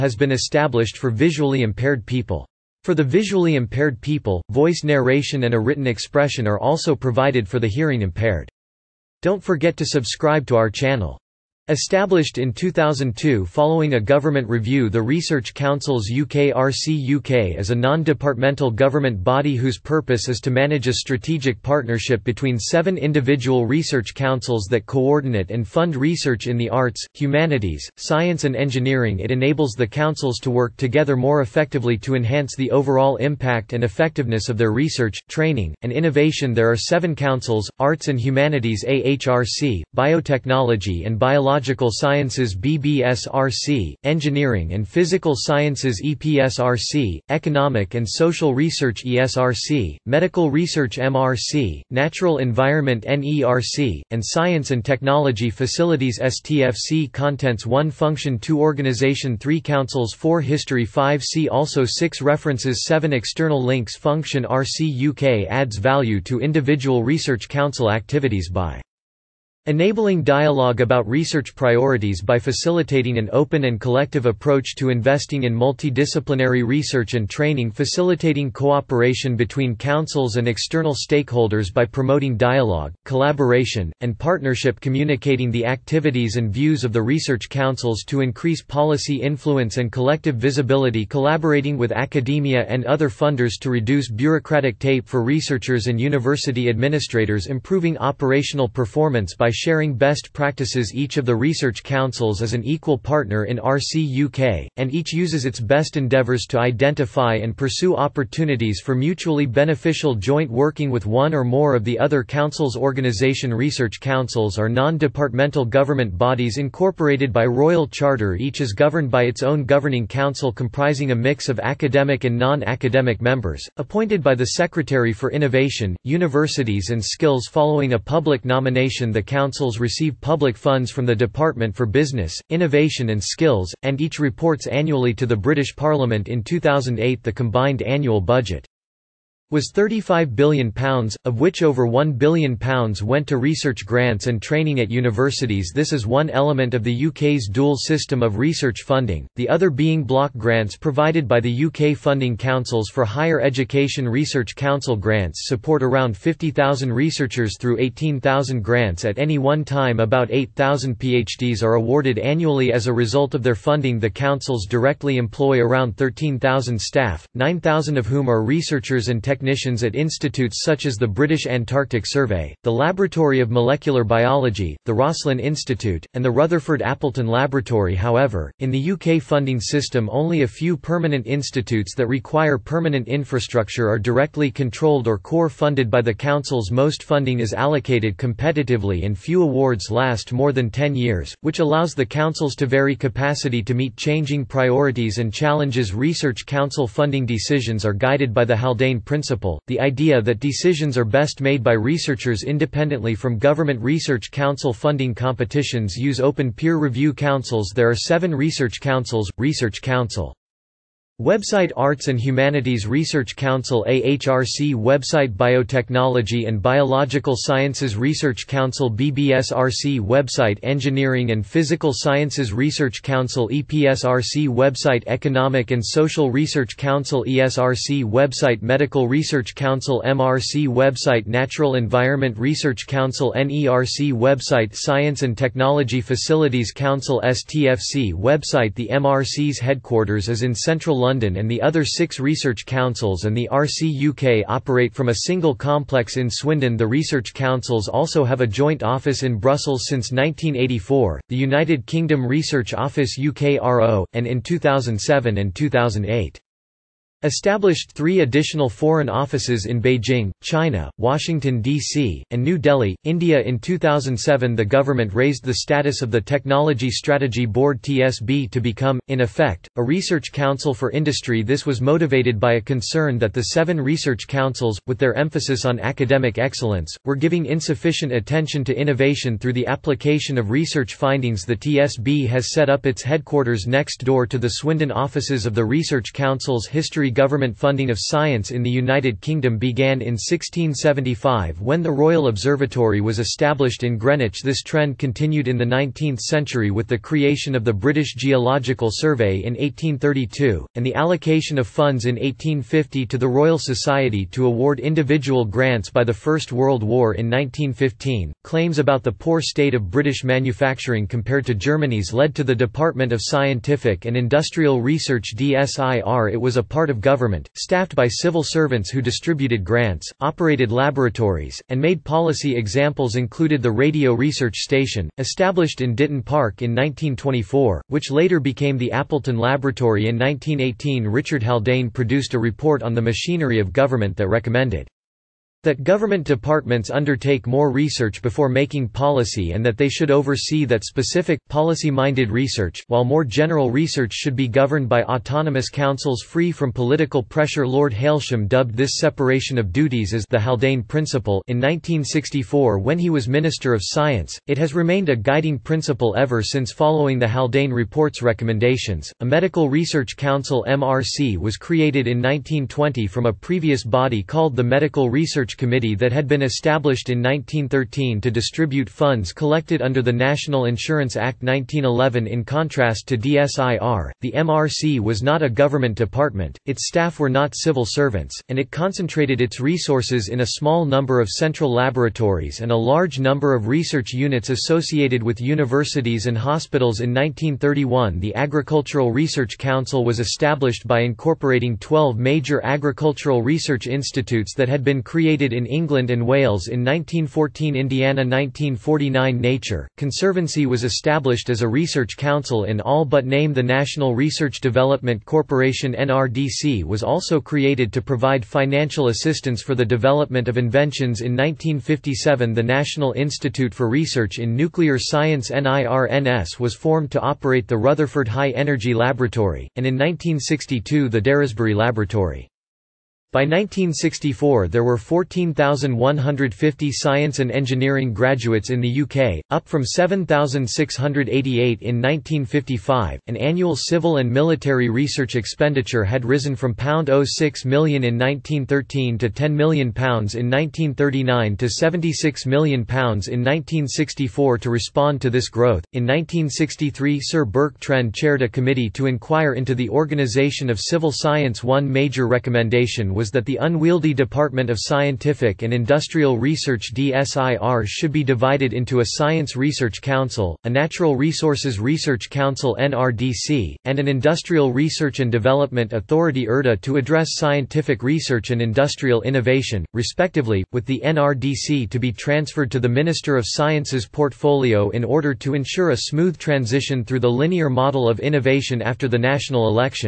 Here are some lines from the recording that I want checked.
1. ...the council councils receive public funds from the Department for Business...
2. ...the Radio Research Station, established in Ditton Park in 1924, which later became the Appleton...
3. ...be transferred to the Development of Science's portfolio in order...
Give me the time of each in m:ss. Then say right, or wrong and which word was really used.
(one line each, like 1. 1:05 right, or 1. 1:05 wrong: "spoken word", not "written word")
1. 2:09 right
2. 5:23 right
3. 7:51 wrong: "Minister", not "Development".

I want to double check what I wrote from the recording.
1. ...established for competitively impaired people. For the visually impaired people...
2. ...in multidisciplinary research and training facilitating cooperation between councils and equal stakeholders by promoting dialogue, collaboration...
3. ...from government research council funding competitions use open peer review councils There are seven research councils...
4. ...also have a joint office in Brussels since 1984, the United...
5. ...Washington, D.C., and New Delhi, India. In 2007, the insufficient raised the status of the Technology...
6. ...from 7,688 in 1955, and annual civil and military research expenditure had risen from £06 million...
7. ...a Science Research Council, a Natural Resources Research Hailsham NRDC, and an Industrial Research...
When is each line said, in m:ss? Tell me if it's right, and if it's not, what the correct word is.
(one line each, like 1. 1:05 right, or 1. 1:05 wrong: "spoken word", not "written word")
1. 0:00 wrong: "visually", not "competitively"
2. 1:15 wrong: "external", not "equal"
3. 3:23 right
4. 4:07 right
5. 4:20 wrong: "government", not "insufficient"
6. 7:09 right
7. 7:39 wrong: "Council", not "Hailsham".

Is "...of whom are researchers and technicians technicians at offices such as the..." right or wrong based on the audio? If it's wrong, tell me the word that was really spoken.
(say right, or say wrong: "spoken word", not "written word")
wrong: "institutes", not "offices".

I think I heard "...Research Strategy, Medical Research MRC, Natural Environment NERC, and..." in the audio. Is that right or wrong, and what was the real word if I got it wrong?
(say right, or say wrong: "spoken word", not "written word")
wrong: "ESRC", not "Strategy".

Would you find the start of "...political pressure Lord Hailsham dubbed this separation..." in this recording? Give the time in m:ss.
5:46.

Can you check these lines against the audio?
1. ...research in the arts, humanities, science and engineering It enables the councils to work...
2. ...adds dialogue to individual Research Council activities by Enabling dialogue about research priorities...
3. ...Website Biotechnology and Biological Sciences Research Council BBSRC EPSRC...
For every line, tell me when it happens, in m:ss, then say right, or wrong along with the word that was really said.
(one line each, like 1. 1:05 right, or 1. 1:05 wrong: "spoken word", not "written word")
1. 0:25 right
2. 1:05 wrong: "value", not "dialogue"
3. 3:34 wrong: "Website", not "EPSRC".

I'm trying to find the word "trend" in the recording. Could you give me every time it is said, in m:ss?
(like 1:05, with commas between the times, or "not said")
4:54, 7:27.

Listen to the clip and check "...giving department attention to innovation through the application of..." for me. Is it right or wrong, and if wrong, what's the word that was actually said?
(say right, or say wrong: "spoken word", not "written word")
wrong: "insufficient", not "department".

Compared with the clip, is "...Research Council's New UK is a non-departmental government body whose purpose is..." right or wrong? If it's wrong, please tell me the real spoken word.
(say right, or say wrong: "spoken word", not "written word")
wrong: "UKRC", not "New".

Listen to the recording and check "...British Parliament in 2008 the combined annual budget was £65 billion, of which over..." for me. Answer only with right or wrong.
wrong.